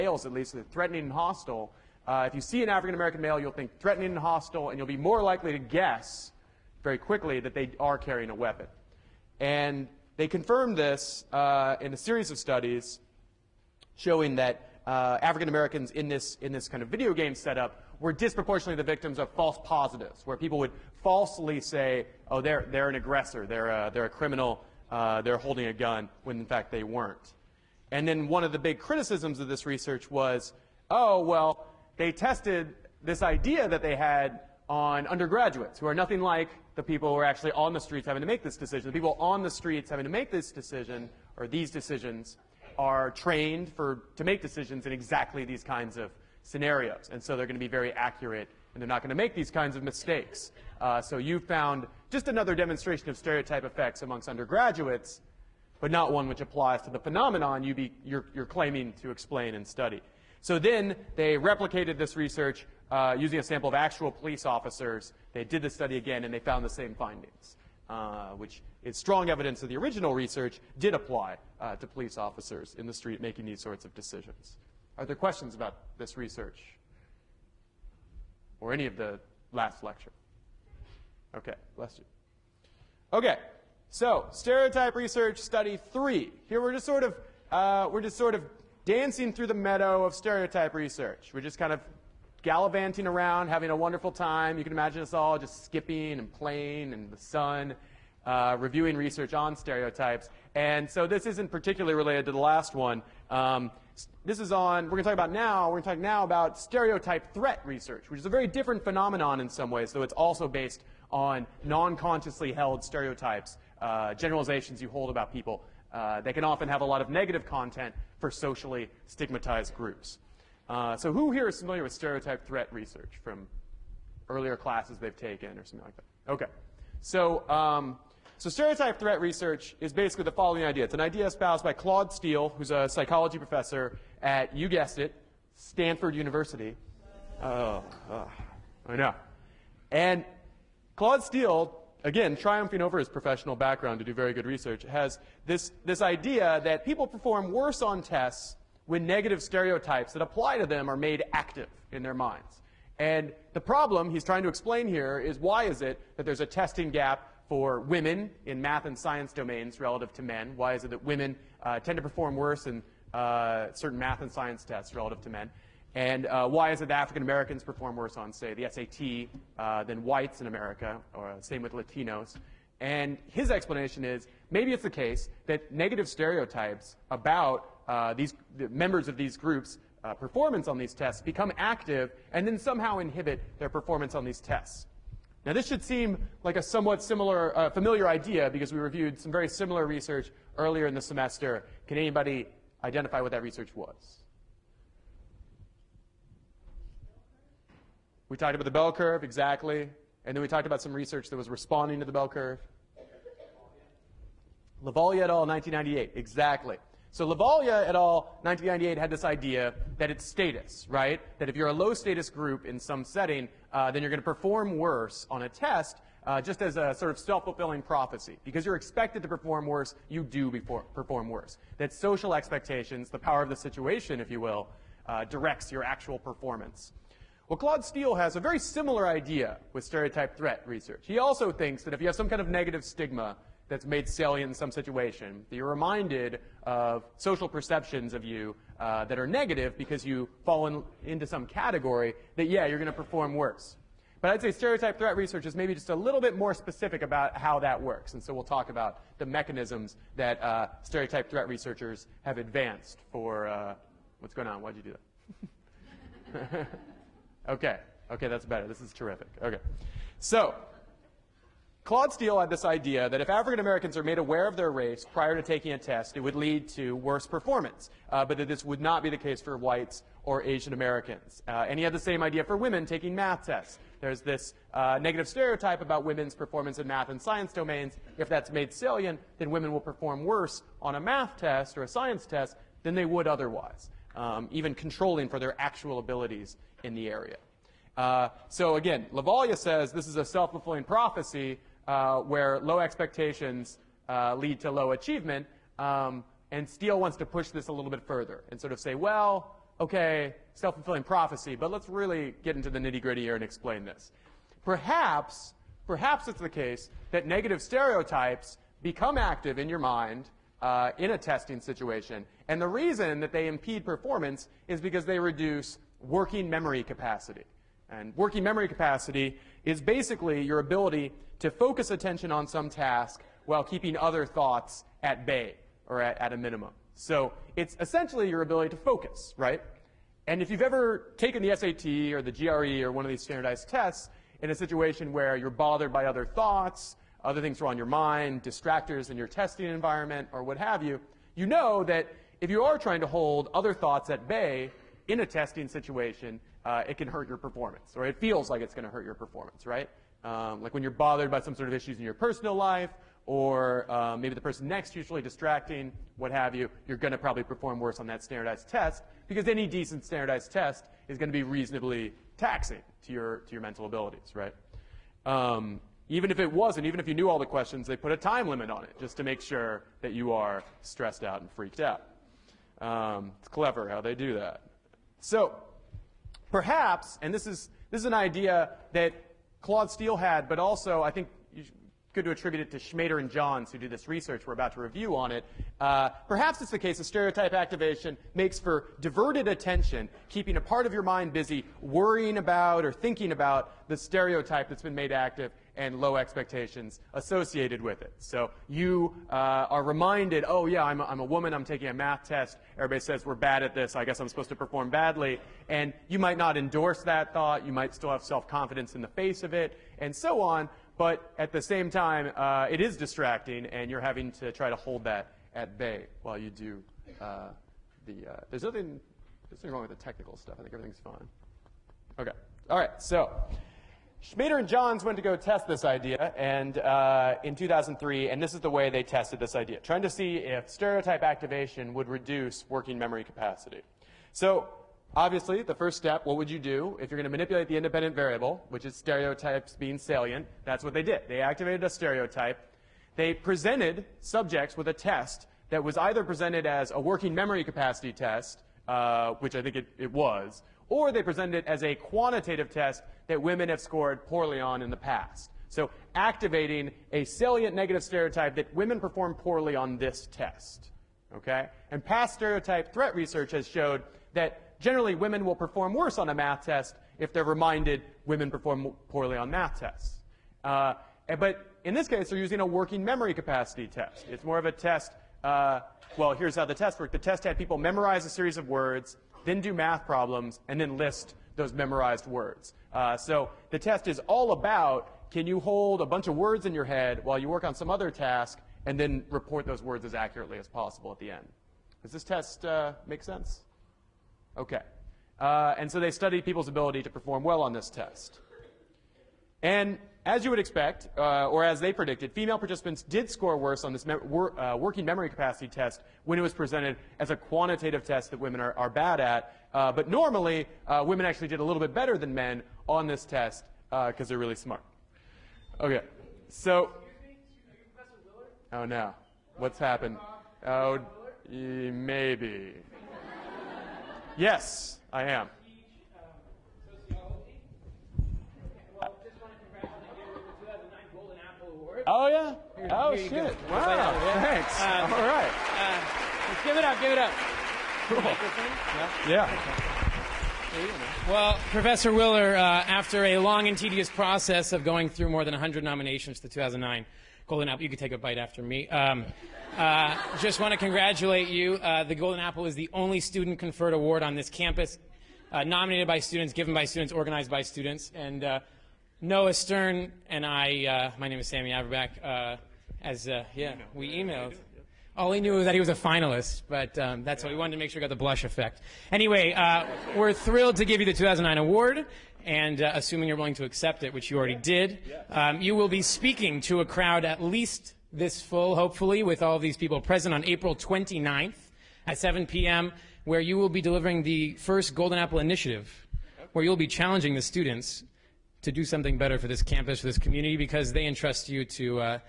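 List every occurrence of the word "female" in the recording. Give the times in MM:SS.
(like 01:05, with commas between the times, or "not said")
08:22.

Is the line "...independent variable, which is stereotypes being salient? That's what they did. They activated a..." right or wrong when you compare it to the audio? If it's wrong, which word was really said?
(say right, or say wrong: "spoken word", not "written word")
right.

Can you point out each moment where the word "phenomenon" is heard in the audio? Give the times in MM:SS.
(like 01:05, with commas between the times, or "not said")
00:56, 01:48.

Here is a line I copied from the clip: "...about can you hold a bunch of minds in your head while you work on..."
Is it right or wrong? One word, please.
wrong.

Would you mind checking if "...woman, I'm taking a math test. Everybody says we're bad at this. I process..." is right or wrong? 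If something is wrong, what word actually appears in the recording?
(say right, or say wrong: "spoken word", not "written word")
wrong: "guess", not "process".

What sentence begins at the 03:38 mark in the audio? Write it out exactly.
Because you're expected to perform worse, you do before, perform worse.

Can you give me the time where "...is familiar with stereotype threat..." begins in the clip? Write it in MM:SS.
02:01.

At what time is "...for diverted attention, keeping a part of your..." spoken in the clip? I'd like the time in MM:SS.
06:28.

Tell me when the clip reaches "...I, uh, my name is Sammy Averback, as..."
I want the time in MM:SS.
09:20.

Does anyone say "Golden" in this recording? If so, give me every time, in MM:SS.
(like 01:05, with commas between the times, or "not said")
09:07, 09:12, 09:44.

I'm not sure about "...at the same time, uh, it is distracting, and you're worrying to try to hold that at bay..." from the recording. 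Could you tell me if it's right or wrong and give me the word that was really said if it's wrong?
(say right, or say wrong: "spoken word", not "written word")
wrong: "having", not "worrying".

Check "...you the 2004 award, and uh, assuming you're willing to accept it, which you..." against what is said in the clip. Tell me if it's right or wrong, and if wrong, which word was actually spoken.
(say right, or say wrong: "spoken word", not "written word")
wrong: "2009", not "2004".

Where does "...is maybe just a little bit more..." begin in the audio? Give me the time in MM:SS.
04:05.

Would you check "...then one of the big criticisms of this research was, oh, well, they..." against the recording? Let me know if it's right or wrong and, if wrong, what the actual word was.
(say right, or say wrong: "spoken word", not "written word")
right.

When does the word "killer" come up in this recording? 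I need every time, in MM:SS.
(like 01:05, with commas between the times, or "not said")
not said.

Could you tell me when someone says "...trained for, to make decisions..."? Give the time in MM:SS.
00:43.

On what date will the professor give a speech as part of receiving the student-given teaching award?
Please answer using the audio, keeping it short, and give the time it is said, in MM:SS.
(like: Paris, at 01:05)
April 29th, at 09:40.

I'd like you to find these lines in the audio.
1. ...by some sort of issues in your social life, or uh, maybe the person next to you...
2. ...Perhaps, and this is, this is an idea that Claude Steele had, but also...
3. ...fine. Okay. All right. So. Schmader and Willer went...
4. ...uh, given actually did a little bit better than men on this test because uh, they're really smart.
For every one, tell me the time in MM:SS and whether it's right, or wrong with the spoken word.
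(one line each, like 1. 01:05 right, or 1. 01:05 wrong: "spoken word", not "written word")
1. 05:51 wrong: "personal", not "social"
2. 06:16 right
3. 07:00 wrong: "Johns", not "Willer"
4. 08:30 wrong: "women", not "given".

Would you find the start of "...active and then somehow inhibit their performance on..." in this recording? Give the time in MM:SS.
03:01.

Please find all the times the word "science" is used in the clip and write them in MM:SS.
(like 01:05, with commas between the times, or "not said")
02:38, 02:44, 04:37, 04:41.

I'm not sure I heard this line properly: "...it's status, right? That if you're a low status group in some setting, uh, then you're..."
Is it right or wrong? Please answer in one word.
right.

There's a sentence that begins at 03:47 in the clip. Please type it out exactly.
Well, Claude Steele has a very similar idea with stereotype threat research.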